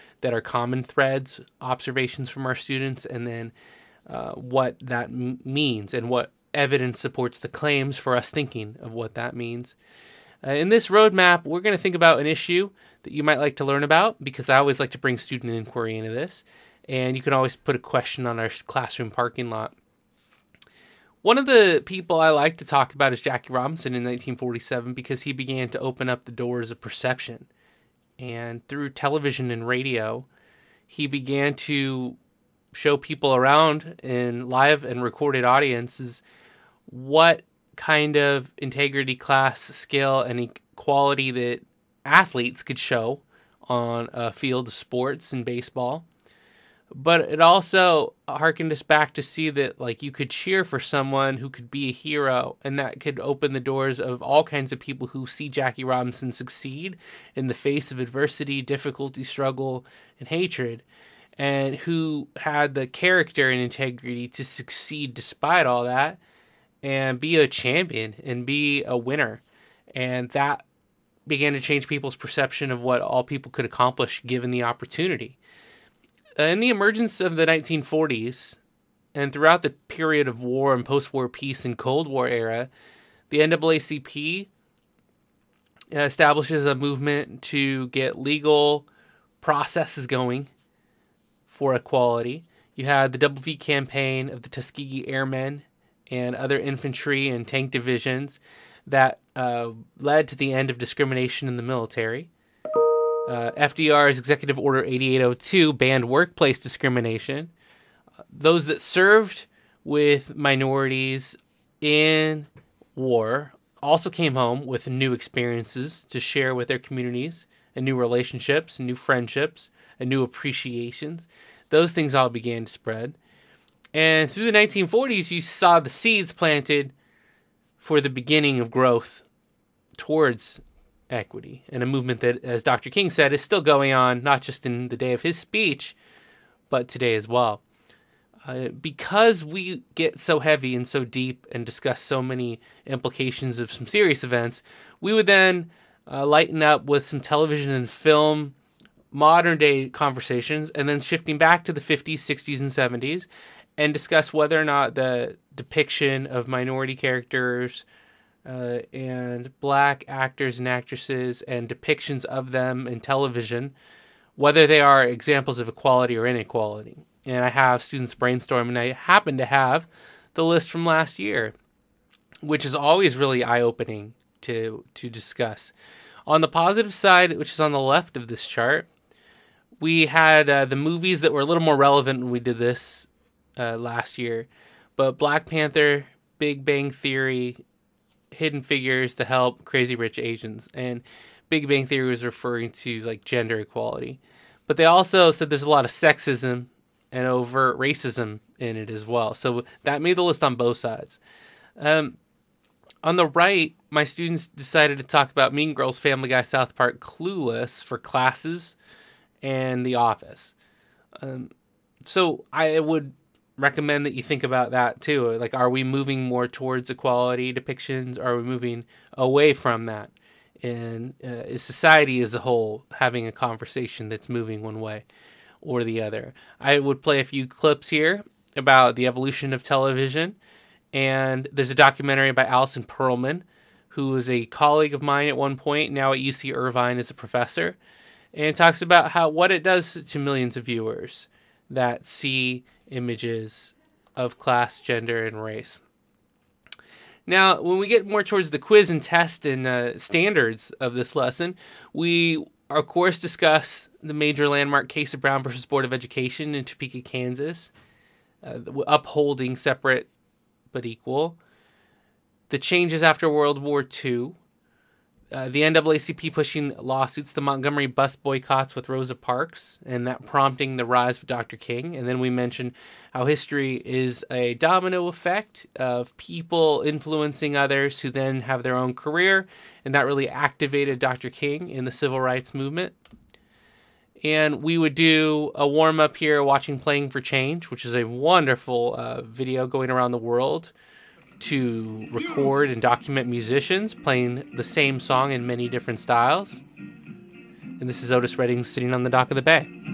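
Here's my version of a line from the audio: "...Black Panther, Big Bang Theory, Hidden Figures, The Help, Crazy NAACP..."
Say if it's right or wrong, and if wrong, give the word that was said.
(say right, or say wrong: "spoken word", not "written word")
wrong: "Rich", not "NAACP".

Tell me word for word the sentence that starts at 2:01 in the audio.
Those things all began to spread.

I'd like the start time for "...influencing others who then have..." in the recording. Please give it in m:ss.
4:36.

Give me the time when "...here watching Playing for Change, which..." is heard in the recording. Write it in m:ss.
4:46.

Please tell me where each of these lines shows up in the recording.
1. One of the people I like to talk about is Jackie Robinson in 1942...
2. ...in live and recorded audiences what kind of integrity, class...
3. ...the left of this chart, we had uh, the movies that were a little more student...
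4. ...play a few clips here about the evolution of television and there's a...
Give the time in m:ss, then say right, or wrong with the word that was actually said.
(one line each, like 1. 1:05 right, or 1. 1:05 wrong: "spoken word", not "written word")
1. 0:21 wrong: "1947", not "1942"
2. 0:34 right
3. 2:57 wrong: "relevant", not "student"
4. 3:47 right.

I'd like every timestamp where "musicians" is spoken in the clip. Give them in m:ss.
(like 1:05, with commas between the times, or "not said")
4:53.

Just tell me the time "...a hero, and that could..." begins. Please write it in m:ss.
0:51.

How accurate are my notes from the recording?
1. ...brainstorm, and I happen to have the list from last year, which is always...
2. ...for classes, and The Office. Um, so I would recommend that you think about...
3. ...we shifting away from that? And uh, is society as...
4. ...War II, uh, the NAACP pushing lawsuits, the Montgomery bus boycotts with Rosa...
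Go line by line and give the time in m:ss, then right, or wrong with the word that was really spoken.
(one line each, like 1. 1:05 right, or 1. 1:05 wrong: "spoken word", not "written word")
1. 2:48 right
2. 3:27 right
3. 3:38 wrong: "moving", not "shifting"
4. 4:23 right.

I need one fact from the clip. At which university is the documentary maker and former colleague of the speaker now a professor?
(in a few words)
UC Irvine.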